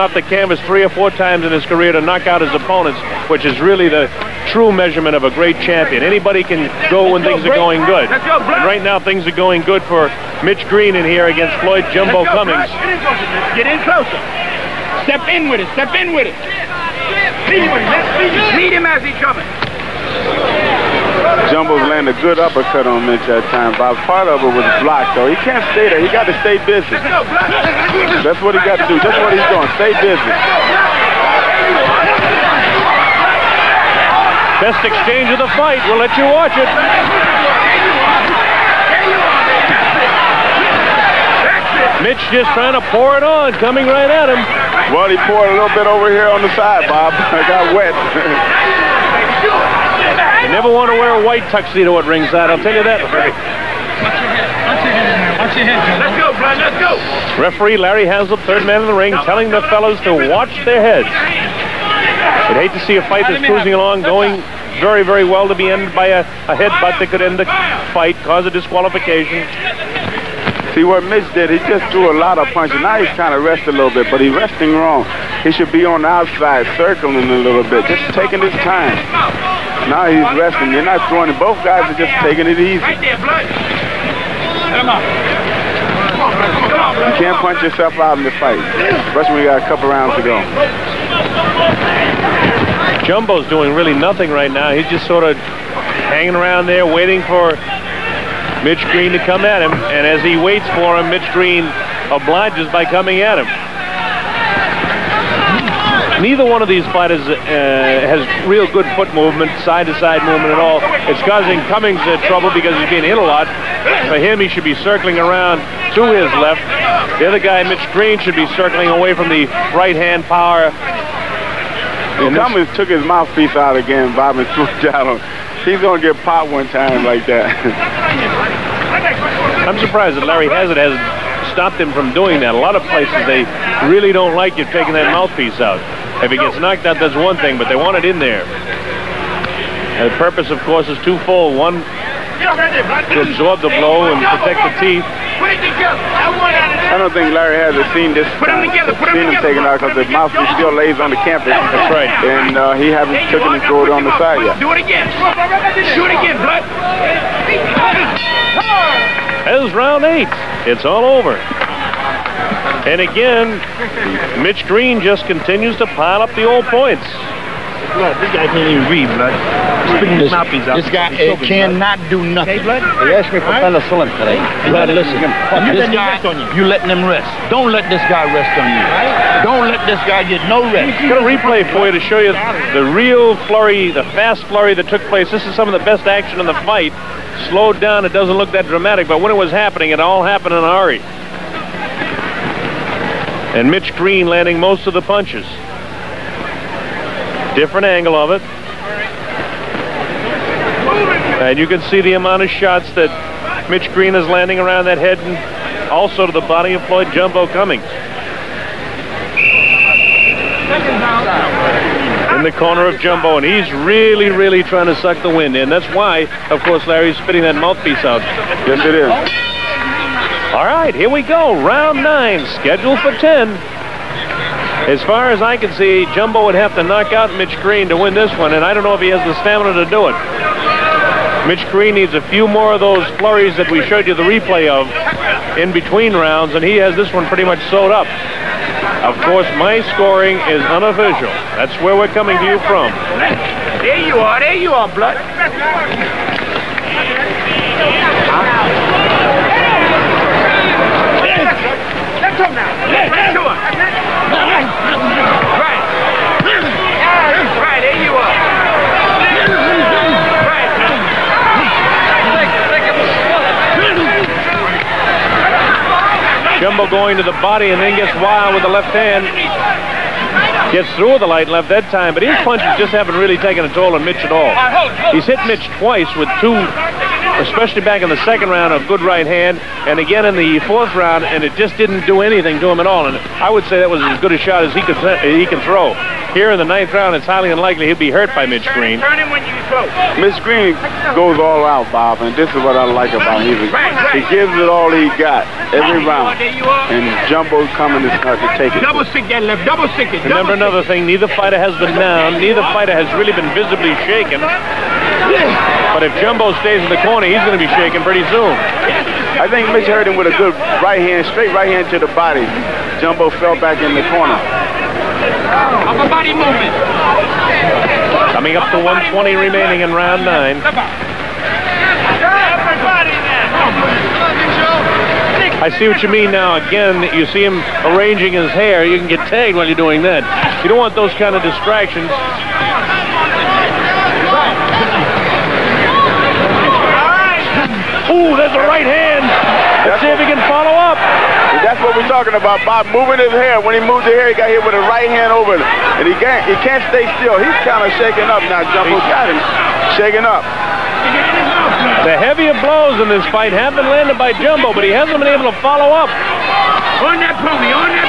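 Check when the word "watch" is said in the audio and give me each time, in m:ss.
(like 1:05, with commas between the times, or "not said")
0:36, 0:53, 1:00.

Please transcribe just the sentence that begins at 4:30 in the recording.
Gets through with the light left that time, but his punches just haven't really taken a toll on Mitch at all.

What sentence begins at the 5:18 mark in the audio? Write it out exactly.
Coming up to 120 remaining in round nine.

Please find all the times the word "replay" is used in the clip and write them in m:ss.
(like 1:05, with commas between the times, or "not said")
3:01, 3:54.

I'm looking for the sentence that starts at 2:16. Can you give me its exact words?
If he gets knocked out, that's one thing, but they want it in there.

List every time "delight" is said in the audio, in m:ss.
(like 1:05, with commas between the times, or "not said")
not said.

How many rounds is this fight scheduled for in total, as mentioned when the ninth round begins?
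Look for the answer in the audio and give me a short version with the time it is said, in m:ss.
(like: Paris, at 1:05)
10, at 3:42.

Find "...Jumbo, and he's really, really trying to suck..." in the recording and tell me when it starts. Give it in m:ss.
3:32.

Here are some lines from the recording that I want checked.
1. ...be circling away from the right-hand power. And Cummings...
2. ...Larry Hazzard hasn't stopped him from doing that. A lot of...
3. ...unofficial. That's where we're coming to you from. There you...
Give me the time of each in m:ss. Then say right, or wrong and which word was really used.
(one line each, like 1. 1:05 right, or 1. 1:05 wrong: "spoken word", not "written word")
1. 1:58 right
2. 2:10 right
3. 4:00 right.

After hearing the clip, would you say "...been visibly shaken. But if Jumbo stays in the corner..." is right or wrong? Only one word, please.
right.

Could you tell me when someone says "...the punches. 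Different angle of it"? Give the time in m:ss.
3:14.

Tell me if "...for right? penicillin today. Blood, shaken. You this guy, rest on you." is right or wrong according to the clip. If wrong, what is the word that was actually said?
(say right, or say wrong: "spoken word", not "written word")
wrong: "listen", not "shaken".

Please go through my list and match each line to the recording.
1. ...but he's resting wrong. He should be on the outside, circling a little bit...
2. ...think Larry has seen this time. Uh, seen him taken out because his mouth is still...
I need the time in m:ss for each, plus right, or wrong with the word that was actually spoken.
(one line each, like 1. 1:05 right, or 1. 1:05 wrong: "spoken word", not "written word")
1. 1:14 right
2. 2:27 right.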